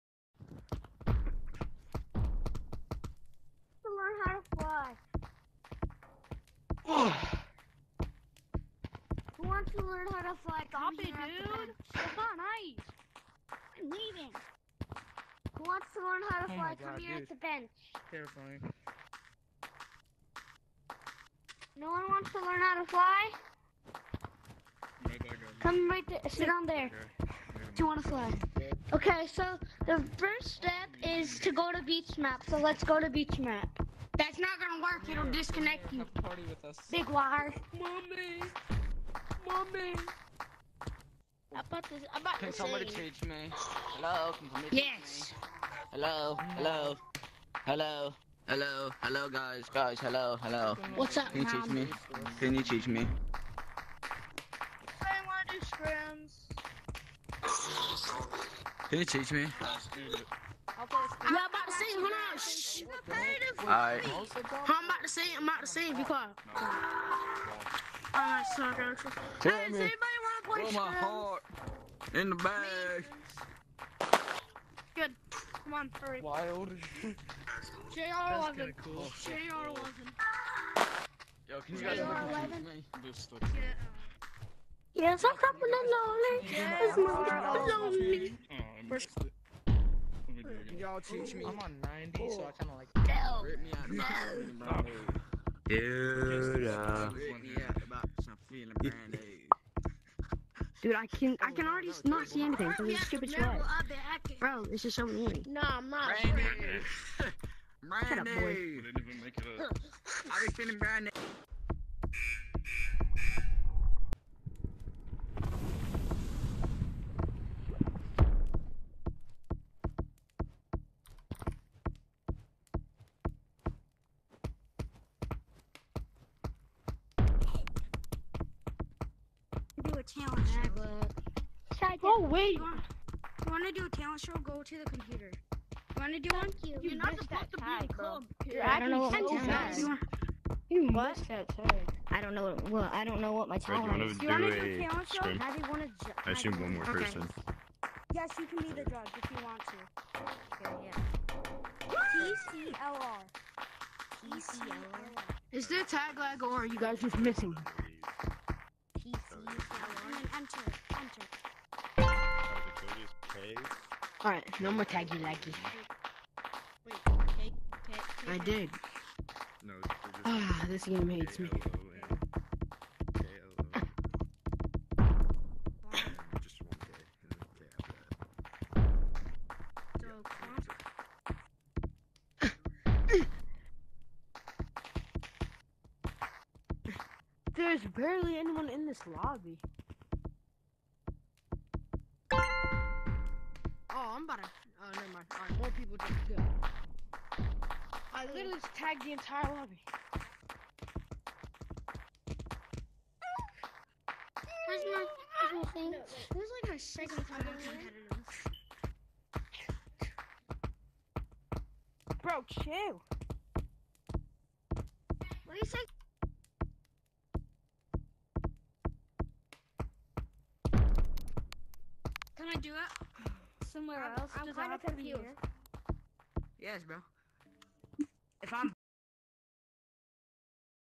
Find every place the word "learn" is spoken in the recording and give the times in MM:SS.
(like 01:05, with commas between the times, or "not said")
00:09, 00:16, 00:22.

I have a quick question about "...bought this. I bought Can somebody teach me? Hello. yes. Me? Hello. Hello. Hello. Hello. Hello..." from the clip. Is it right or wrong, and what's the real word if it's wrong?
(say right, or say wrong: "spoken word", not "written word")
right.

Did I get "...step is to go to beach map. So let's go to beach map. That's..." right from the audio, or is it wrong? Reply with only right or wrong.
right.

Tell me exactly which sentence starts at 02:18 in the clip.
You're yeah, actually know You must I don't know Well, I don't know what my talent is.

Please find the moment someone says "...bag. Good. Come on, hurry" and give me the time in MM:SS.
01:12.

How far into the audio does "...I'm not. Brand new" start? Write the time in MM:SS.
01:45.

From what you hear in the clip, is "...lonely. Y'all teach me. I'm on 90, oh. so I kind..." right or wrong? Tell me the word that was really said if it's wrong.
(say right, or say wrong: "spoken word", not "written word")
right.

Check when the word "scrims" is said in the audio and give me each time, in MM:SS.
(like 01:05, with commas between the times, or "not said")
00:55, 01:01.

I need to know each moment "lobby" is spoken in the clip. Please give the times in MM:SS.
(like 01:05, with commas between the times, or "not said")
03:09, 03:19.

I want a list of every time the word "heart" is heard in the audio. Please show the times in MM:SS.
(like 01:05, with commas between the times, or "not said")
01:10.